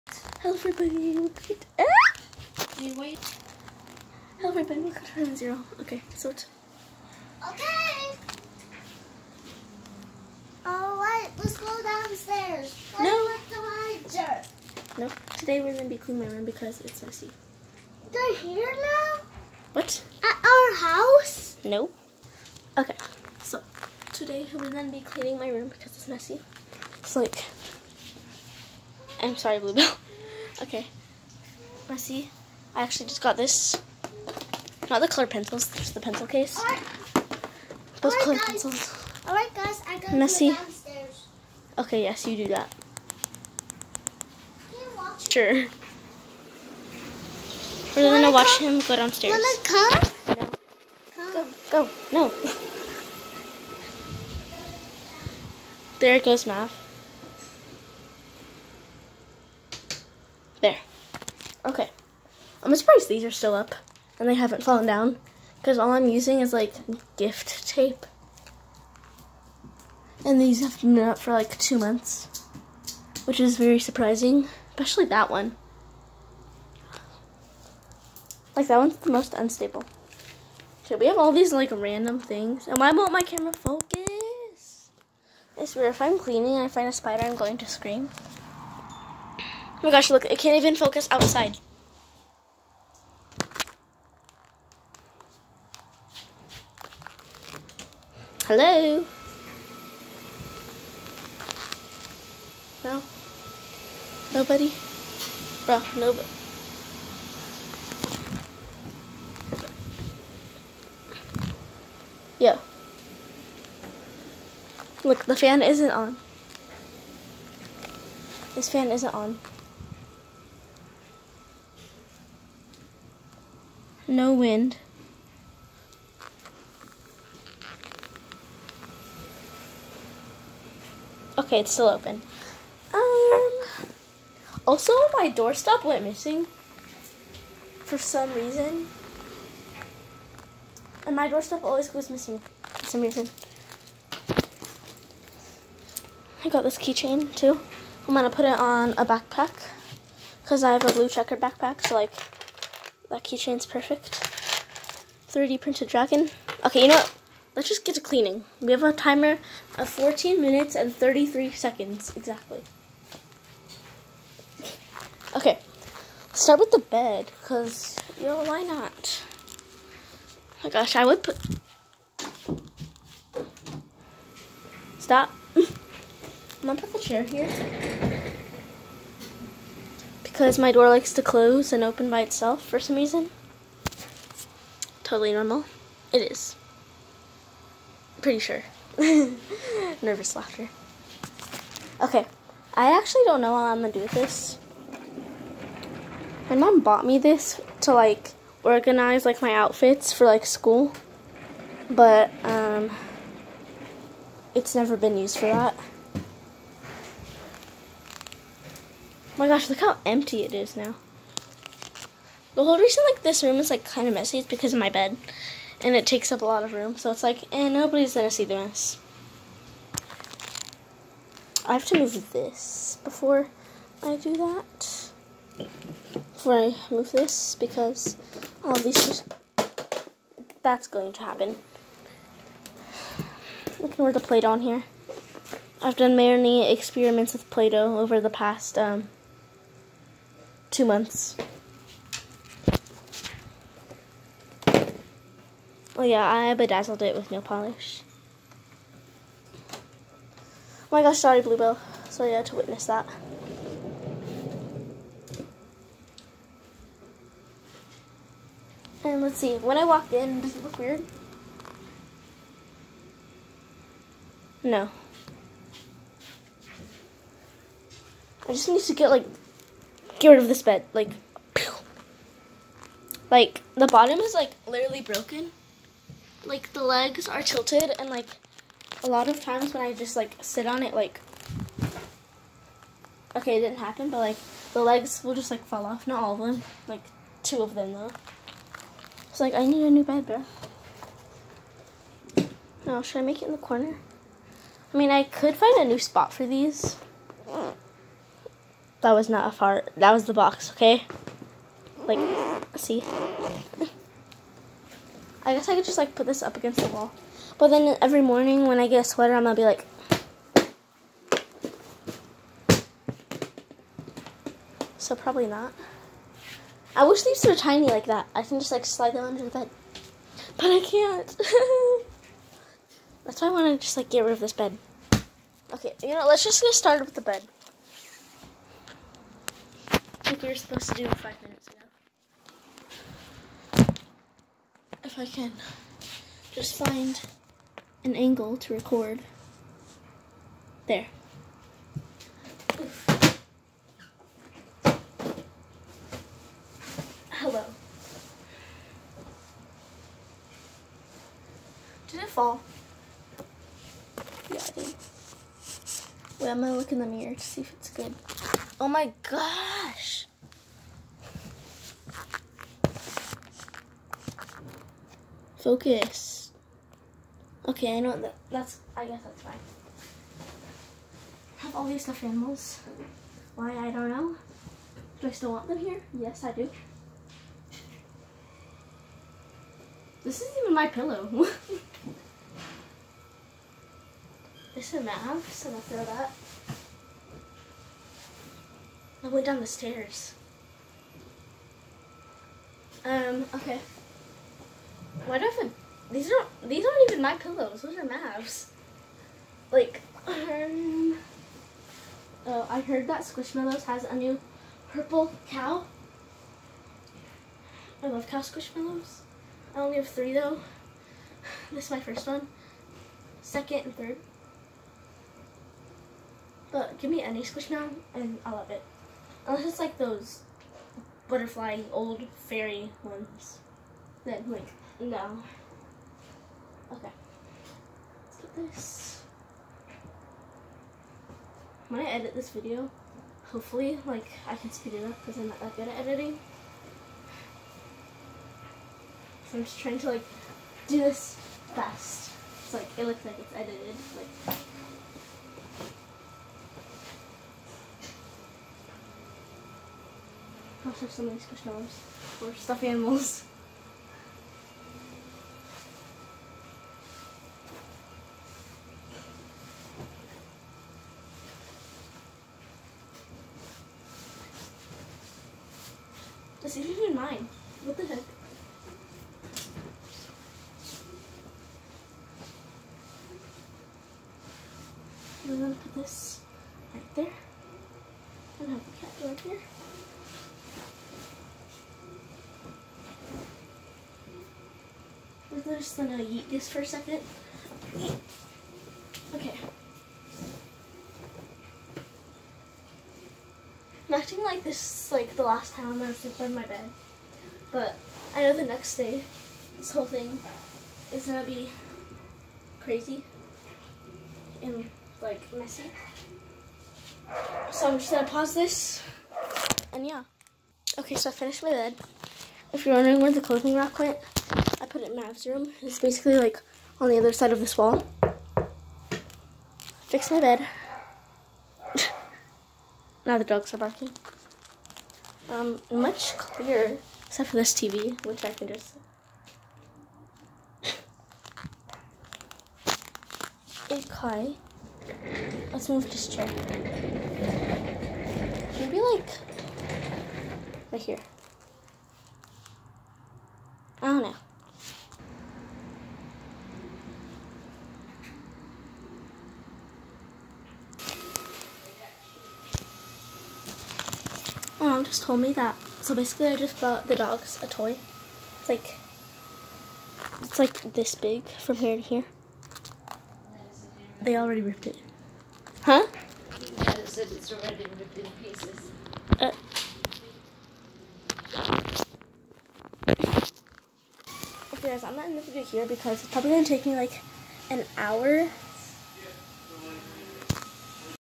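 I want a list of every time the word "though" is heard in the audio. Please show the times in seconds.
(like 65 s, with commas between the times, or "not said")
287 s, 410 s.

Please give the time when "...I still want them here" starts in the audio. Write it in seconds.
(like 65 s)
375 s.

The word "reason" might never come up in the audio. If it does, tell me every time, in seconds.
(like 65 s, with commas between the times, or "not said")
138 s, 143 s, 182 s, 212 s.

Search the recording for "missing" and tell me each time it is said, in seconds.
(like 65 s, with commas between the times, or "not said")
136 s, 142 s.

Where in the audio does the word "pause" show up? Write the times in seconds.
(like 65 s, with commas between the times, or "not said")
508 s.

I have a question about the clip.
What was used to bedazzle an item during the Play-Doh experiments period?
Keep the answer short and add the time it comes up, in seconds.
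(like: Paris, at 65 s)
nail polish, at 247 s.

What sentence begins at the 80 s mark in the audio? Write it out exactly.
So we have all these like random things.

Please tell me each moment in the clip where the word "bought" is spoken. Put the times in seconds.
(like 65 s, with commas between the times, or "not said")
196 s, 556 s.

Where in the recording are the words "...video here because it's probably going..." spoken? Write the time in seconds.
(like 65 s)
575 s.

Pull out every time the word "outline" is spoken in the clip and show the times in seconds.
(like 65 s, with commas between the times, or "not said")
not said.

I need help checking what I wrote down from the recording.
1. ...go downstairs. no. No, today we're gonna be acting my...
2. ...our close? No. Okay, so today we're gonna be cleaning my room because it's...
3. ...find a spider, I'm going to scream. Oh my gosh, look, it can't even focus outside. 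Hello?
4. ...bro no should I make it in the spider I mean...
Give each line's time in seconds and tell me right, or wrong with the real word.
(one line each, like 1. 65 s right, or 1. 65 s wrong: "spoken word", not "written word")
1. 11 s wrong: "cleaning", not "acting"
2. 20 s wrong: "house", not "close"
3. 86 s right
4. 290 s wrong: "corner", not "spider".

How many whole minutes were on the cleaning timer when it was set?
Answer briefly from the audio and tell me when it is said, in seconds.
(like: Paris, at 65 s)
14, at 159 s.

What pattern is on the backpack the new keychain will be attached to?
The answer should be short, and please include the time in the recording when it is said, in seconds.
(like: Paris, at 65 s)
blue checkered, at 150 s.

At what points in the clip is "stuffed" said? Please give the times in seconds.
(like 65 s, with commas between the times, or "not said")
372 s, 452 s.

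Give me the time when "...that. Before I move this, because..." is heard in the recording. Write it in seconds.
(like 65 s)
224 s.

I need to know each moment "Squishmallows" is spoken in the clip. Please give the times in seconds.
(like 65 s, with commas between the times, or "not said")
403 s, 408 s, 417 s.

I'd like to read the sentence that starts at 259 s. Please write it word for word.
And let's see, when I walked in, does it look weird?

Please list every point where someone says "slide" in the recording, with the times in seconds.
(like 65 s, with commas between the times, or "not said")
318 s.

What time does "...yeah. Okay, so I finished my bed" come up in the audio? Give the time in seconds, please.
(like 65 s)
510 s.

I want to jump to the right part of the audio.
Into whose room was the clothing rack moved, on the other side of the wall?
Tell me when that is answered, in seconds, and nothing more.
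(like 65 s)
515 s.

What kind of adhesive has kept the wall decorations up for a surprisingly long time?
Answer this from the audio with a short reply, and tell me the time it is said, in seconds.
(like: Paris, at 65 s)
gift tape, at 67 s.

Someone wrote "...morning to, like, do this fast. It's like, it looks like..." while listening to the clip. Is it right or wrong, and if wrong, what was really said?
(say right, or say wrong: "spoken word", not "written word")
wrong: "trying", not "morning".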